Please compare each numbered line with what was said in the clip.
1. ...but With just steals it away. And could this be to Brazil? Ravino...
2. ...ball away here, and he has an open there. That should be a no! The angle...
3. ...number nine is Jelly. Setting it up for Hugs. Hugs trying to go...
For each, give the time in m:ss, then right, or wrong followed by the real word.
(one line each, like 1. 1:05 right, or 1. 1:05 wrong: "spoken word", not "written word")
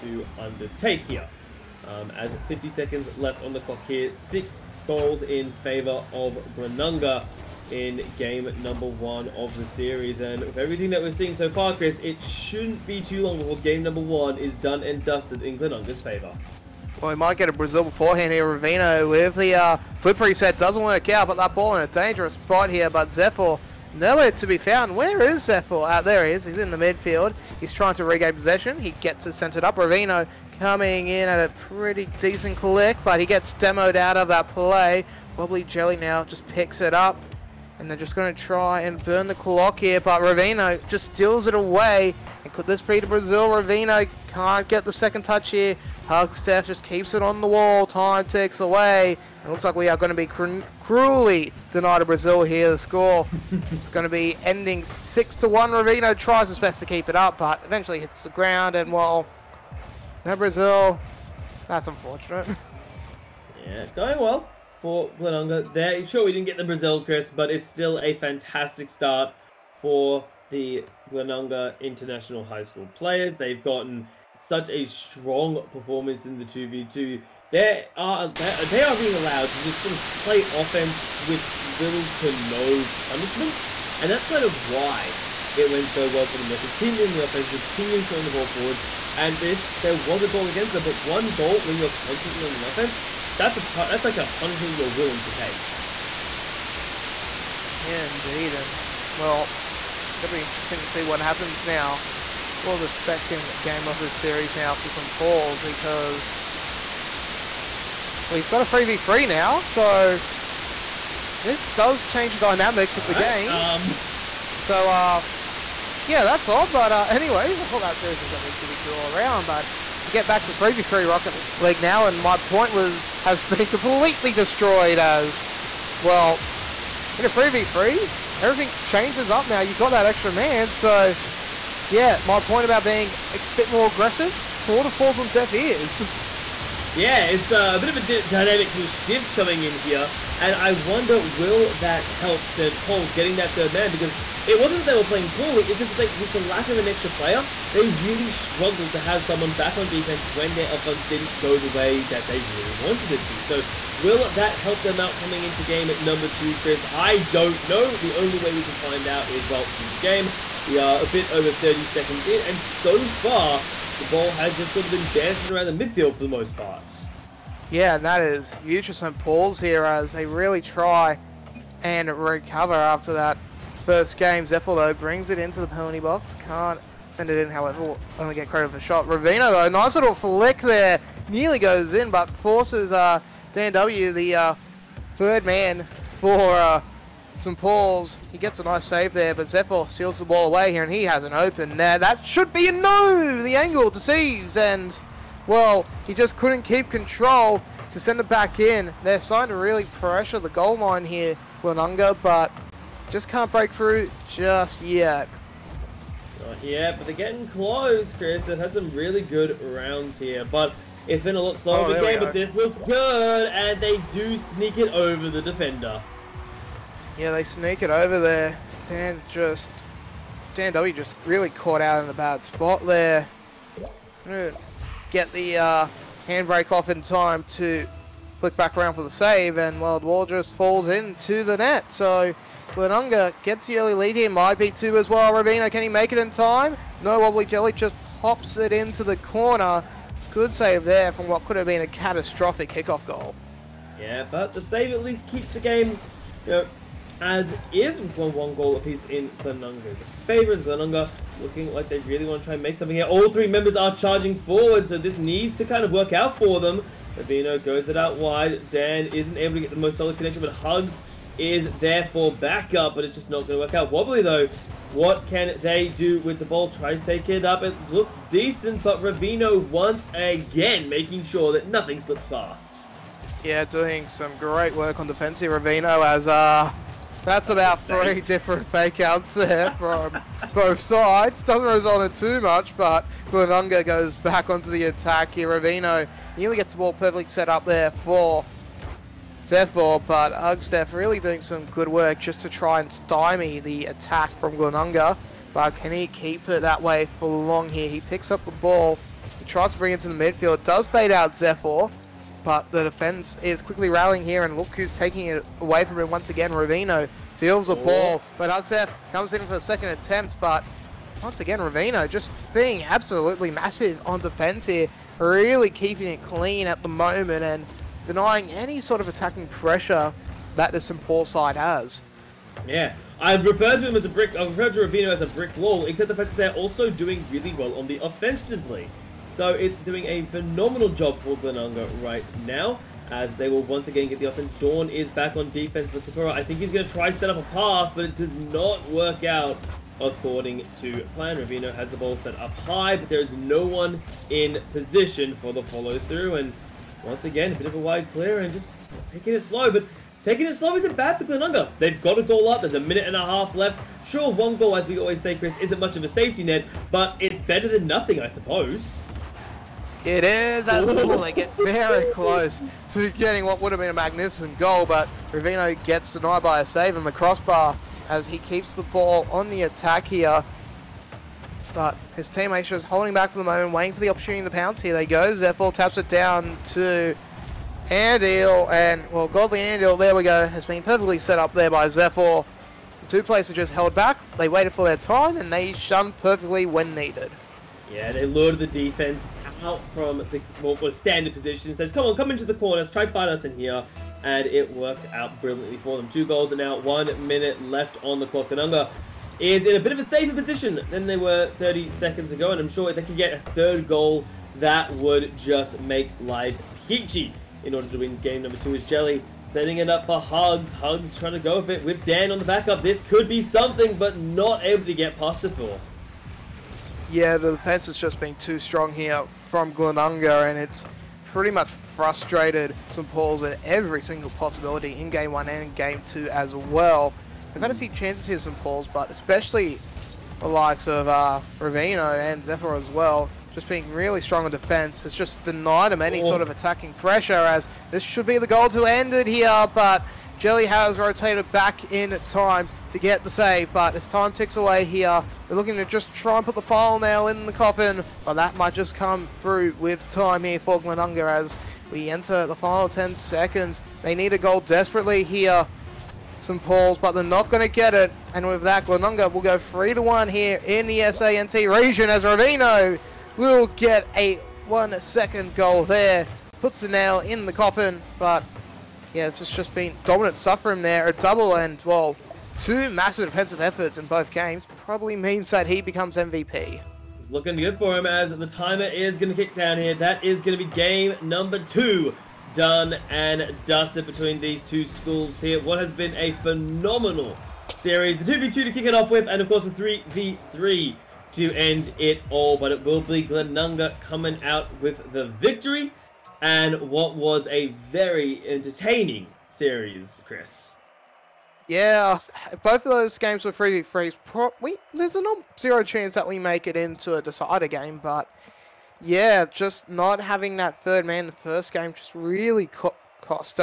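1. 0:39 wrong: "Ravino", not "With"
2. 3:10 right
3. 6:48 wrong: "two", not "nine".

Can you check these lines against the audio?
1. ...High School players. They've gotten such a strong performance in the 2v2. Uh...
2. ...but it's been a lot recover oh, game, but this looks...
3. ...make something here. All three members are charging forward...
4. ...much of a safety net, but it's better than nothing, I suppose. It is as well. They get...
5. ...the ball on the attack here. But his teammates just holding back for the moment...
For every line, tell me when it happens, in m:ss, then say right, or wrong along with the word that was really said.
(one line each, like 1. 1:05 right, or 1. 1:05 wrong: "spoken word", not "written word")
1. 1:12 right
2. 3:30 wrong: "slower", not "recover"
3. 4:12 right
4. 5:55 right
5. 6:08 right.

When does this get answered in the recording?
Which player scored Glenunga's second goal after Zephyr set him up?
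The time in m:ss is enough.
6:19.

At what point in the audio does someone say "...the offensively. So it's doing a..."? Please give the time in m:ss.
5:27.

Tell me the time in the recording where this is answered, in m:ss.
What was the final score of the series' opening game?
0:54.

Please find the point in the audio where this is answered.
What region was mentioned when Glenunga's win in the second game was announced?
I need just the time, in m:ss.
7:41.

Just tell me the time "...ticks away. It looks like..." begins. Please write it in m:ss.
0:48.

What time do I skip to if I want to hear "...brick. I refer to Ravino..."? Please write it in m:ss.
5:24.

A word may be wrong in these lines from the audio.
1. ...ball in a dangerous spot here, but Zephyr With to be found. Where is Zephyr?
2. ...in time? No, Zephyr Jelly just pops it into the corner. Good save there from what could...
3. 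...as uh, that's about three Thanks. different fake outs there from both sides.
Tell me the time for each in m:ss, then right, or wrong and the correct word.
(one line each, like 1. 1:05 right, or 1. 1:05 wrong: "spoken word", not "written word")
1. 0:21 wrong: "Nowhere", not "With"
2. 3:56 wrong: "Wobbly", not "Zephyr"
3. 4:36 right.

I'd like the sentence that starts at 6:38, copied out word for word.
Glenunga is in a bit of a safer position than they were 30 seconds ago.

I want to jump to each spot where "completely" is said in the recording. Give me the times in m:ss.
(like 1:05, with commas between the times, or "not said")
2:03.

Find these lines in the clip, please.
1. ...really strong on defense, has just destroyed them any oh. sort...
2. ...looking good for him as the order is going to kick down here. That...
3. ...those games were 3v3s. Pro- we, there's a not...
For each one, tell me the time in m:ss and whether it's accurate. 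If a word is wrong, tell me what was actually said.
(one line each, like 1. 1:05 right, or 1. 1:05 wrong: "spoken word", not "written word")
1. 7:13 wrong: "denied", not "destroyed"
2. 7:57 wrong: "timer", not "order"
3. 8:22 right.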